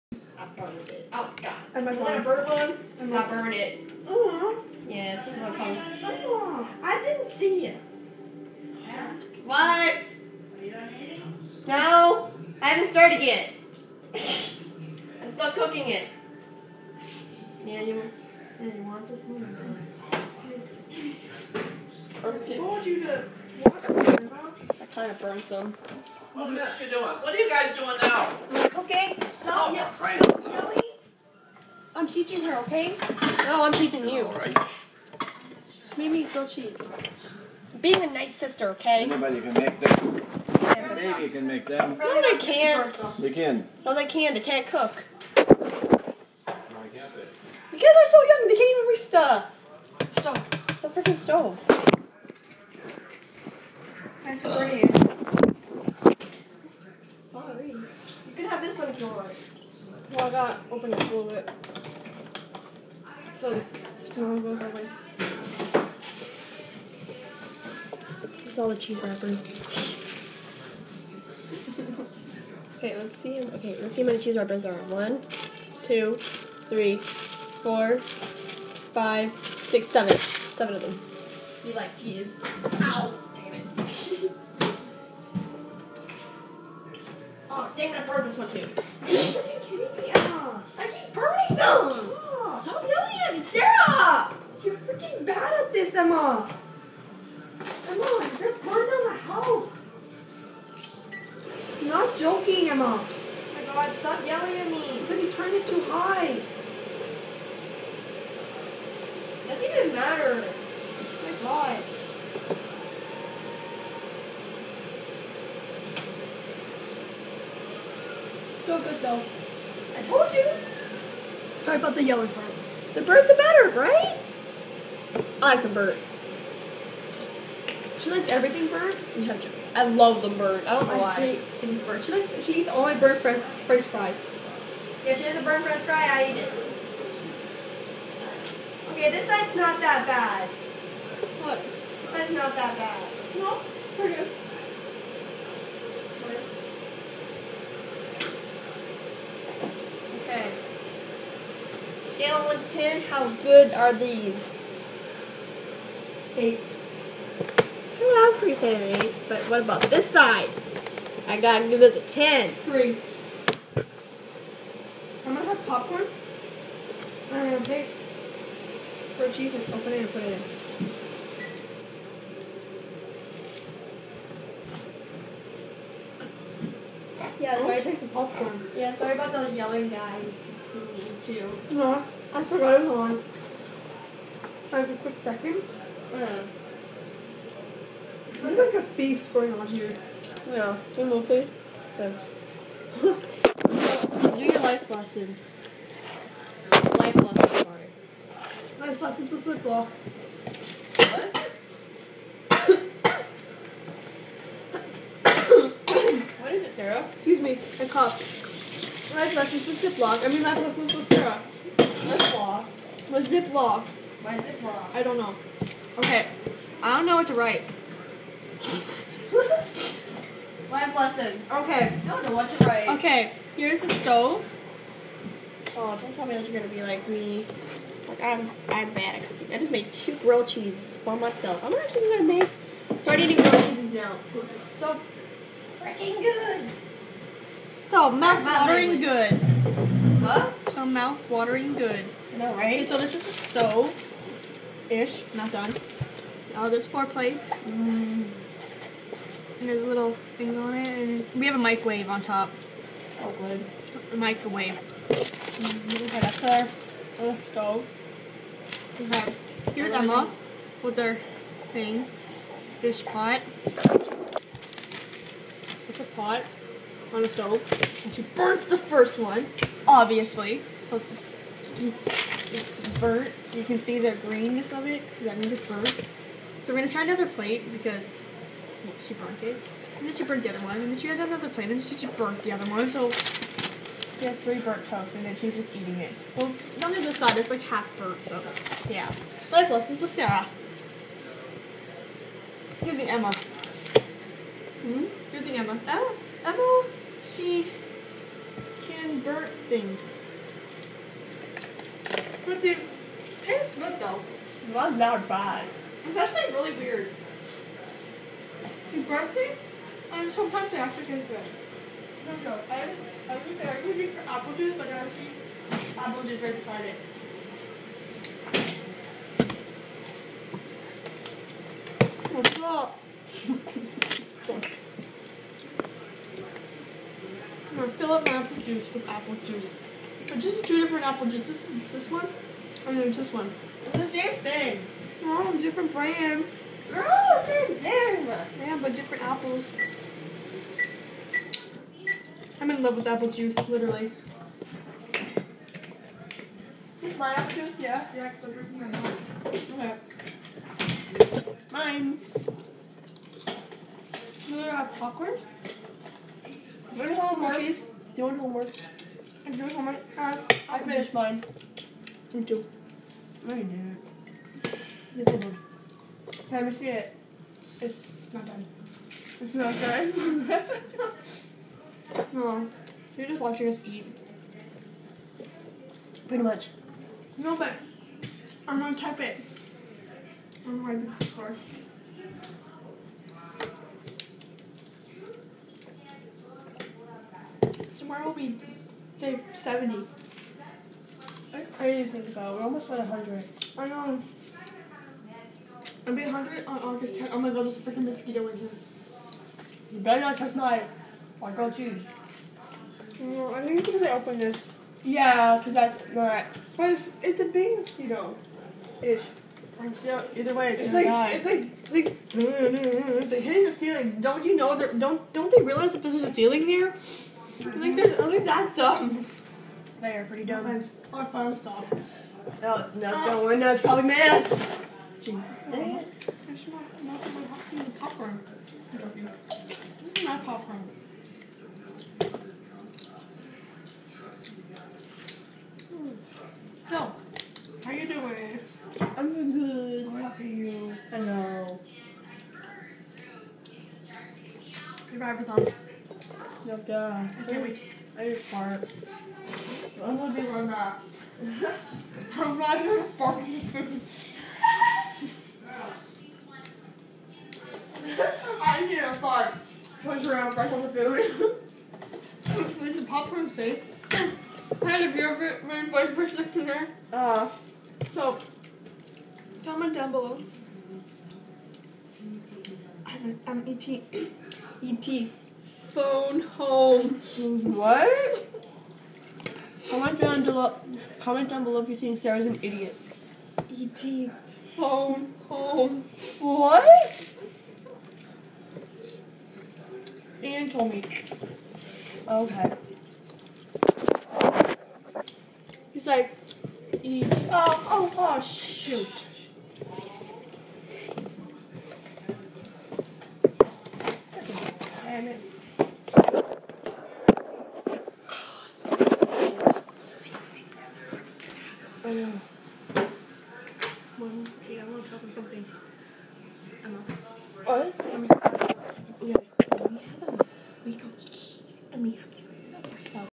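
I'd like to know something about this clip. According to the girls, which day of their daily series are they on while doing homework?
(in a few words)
Day 70.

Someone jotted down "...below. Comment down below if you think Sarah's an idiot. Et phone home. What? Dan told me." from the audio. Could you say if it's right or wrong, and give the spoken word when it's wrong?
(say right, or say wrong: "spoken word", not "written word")
right.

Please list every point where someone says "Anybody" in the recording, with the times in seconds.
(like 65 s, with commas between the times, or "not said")
39 s.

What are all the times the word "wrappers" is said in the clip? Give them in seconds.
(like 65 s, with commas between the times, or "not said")
69 s, 74 s.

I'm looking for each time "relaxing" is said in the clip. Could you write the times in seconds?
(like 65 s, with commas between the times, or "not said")
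not said.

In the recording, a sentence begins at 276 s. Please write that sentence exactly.
So we're gonna try another plate because well, she burnt it.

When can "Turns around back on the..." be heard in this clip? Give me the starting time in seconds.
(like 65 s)
460 s.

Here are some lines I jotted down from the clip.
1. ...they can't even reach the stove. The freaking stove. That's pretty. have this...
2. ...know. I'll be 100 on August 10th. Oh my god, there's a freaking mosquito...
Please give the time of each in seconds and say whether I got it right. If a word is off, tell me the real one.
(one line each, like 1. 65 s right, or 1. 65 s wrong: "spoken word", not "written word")
1. 48 s right
2. 393 s right.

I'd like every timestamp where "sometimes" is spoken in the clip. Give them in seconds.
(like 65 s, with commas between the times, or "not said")
310 s.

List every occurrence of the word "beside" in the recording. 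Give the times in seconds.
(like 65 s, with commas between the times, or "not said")
316 s.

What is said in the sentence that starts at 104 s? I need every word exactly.
Because you turned it too high!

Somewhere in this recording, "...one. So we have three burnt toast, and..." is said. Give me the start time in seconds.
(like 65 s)
282 s.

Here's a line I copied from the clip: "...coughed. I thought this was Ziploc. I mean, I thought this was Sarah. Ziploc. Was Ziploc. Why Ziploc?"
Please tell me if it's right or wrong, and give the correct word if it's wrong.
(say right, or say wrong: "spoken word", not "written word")
right.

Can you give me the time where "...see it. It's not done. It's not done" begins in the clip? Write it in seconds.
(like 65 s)
366 s.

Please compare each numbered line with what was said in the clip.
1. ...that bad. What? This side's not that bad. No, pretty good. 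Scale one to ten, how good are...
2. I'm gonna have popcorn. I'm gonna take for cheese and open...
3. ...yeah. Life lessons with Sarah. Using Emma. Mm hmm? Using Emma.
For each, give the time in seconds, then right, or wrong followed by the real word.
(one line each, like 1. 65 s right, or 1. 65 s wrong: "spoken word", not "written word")
1. 139 s right
2. 165 s right
3. 288 s right.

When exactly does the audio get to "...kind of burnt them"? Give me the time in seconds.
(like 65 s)
24 s.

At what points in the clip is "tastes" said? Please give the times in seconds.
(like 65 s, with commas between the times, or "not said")
303 s, 311 s.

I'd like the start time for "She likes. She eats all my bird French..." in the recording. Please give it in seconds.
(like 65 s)
132 s.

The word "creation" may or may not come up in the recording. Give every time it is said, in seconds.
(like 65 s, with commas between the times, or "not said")
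not said.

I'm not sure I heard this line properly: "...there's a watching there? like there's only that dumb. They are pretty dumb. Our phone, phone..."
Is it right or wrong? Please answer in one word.
wrong.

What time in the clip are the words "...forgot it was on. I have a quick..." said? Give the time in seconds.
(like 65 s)
182 s.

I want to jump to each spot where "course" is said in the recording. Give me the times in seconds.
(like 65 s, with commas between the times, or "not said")
381 s.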